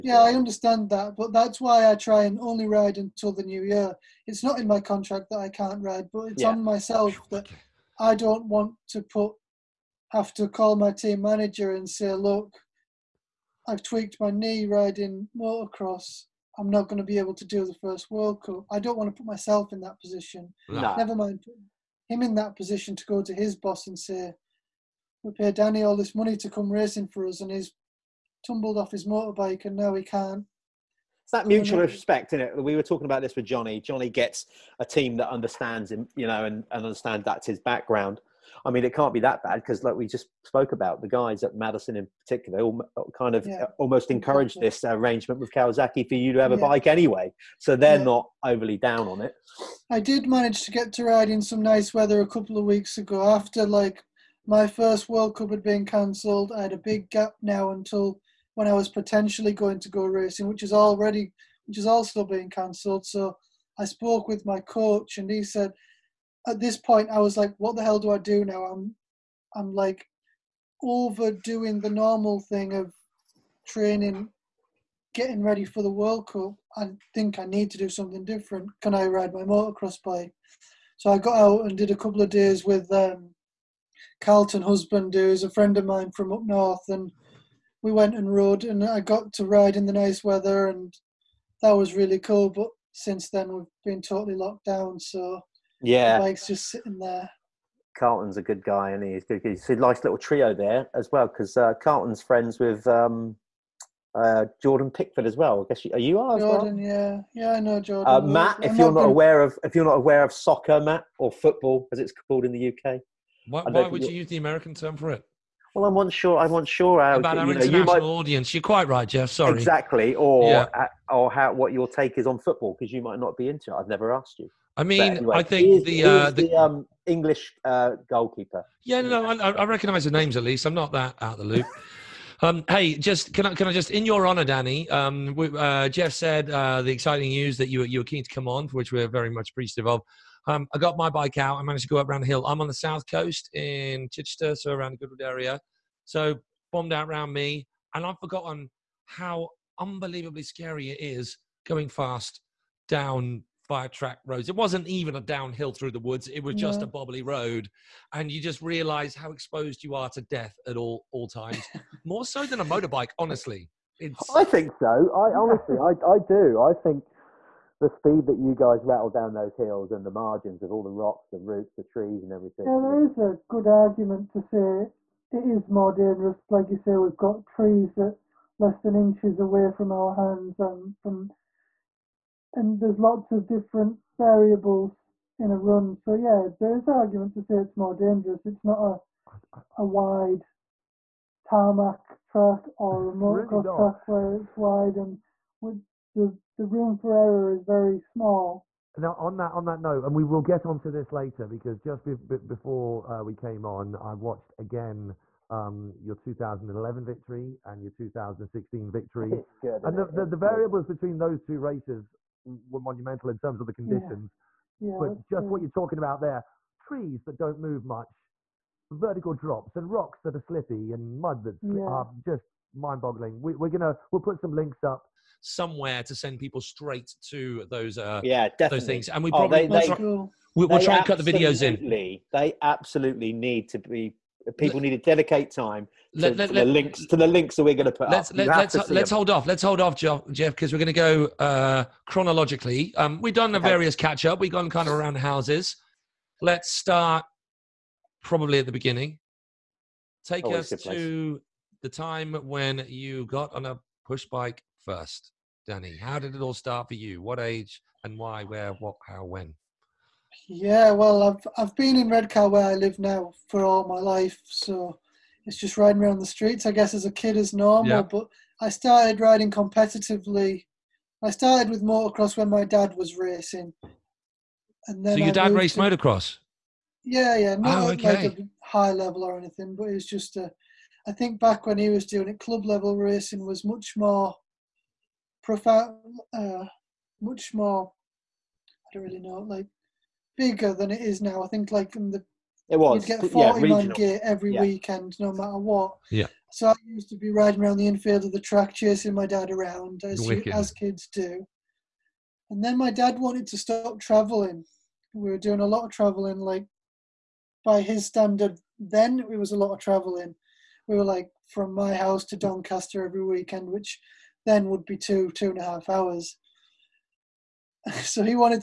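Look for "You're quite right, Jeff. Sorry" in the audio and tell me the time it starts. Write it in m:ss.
1:58.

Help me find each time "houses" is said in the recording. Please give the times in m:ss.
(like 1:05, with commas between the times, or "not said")
4:05, 5:11.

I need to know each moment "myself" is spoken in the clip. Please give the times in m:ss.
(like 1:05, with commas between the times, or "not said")
0:06, 0:19.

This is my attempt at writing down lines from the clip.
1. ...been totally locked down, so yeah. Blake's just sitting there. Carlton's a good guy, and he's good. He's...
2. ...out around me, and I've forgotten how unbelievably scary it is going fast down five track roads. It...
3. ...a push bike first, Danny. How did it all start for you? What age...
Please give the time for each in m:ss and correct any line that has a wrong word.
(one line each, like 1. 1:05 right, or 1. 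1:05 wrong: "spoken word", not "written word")
1. 1:33 right
2. 2:26 right
3. 4:13 right.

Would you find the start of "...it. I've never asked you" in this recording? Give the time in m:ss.
2:03.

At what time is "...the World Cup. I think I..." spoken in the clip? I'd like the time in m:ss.
1:15.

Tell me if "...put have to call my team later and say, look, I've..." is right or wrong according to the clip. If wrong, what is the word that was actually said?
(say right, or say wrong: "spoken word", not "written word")
wrong: "manager", not "later".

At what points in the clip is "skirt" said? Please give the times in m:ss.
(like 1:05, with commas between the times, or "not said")
not said.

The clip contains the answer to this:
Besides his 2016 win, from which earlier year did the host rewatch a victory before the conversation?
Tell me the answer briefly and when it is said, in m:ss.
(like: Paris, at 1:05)
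2011, at 3:26.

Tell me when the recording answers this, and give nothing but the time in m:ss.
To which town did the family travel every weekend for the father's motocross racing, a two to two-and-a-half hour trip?
5:12.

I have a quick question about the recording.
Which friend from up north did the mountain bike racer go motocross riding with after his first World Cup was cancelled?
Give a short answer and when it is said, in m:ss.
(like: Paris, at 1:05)
Carlton Husband, at 1:24.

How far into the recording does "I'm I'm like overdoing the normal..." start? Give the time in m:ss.
1:08.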